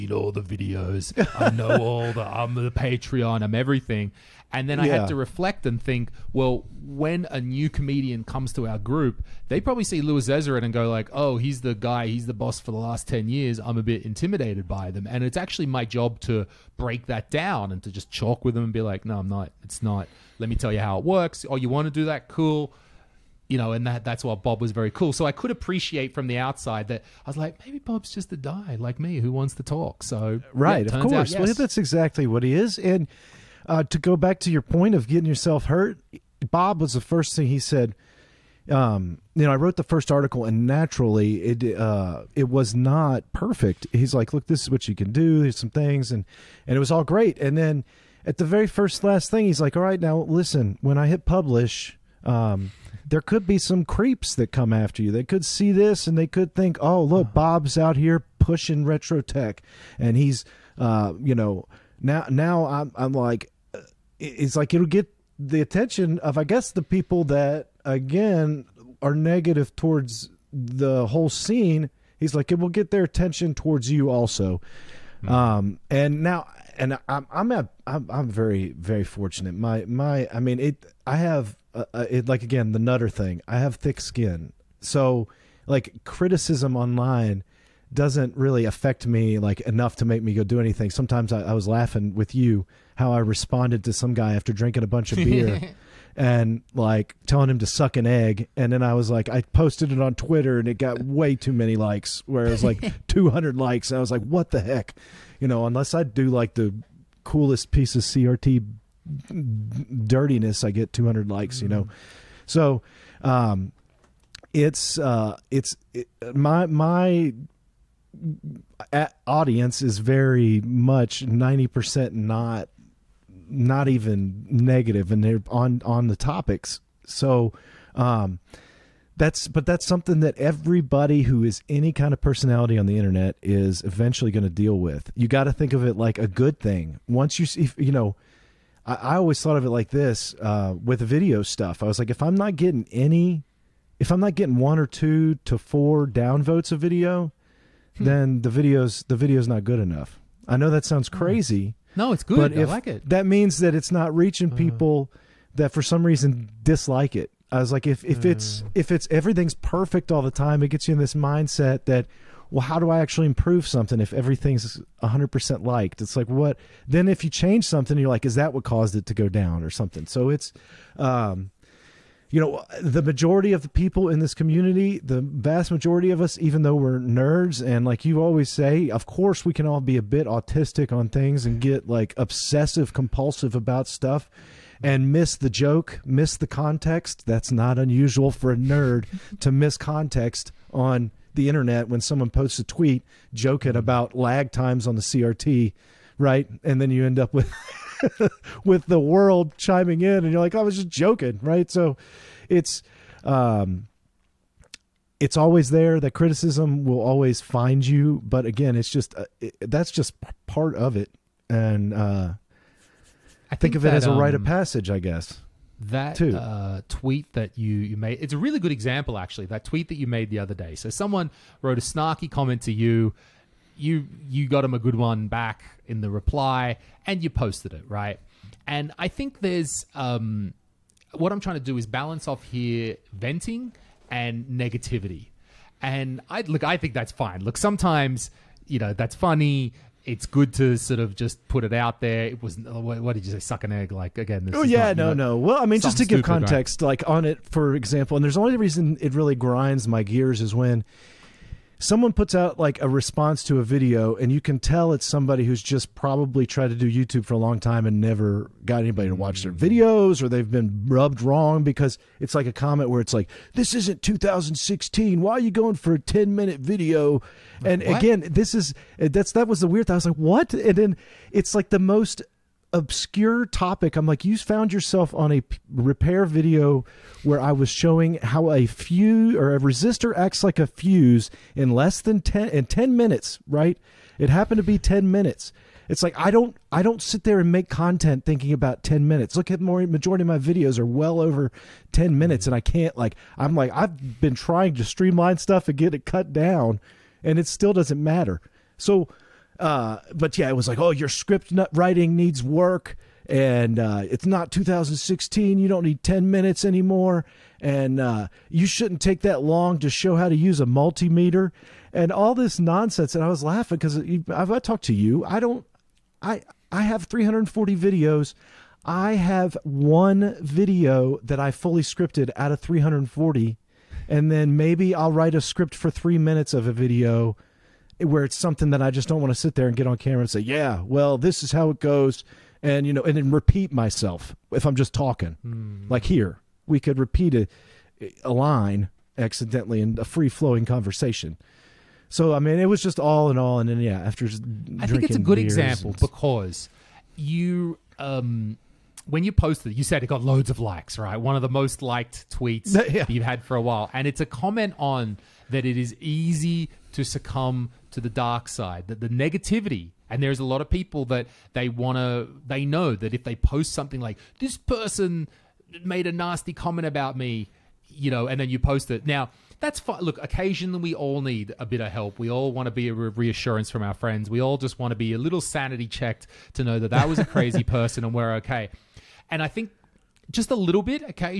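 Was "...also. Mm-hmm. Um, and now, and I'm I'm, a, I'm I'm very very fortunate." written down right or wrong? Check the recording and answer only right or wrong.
right.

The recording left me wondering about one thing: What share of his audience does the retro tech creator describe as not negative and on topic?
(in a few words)
90%.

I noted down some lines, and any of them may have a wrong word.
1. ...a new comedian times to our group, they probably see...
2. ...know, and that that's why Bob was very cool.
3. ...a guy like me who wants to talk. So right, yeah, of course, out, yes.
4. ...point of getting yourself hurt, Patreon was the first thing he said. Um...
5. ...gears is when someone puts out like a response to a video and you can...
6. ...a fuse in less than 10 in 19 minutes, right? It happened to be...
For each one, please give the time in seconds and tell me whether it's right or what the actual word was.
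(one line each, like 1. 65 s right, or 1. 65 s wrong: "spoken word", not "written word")
1. 7 s wrong: "comes", not "times"
2. 23 s right
3. 28 s right
4. 34 s wrong: "Bob", not "Patreon"
5. 250 s right
6. 280 s wrong: "10", not "19".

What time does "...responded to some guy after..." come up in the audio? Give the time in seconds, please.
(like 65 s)
93 s.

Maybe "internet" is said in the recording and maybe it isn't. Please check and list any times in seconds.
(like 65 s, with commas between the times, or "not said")
132 s, 191 s.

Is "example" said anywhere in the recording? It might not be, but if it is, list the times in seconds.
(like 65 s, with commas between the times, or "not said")
218 s, 247 s, 345 s.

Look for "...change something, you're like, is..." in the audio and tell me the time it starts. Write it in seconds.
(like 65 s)
167 s.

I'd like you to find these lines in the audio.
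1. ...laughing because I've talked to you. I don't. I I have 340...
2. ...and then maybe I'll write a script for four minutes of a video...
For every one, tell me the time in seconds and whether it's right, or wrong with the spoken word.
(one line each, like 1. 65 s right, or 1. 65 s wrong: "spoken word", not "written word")
1. 313 s right
2. 324 s wrong: "three", not "four".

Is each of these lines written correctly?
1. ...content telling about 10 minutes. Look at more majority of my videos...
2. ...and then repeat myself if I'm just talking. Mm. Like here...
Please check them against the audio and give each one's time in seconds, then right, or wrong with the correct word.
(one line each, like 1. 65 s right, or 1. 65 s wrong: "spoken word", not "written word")
1. 287 s wrong: "thinking", not "telling"
2. 333 s right.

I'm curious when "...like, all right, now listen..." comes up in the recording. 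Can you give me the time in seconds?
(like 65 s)
49 s.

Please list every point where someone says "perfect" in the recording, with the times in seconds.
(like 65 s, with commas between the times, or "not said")
43 s, 159 s.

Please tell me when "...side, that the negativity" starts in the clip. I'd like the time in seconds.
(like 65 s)
358 s.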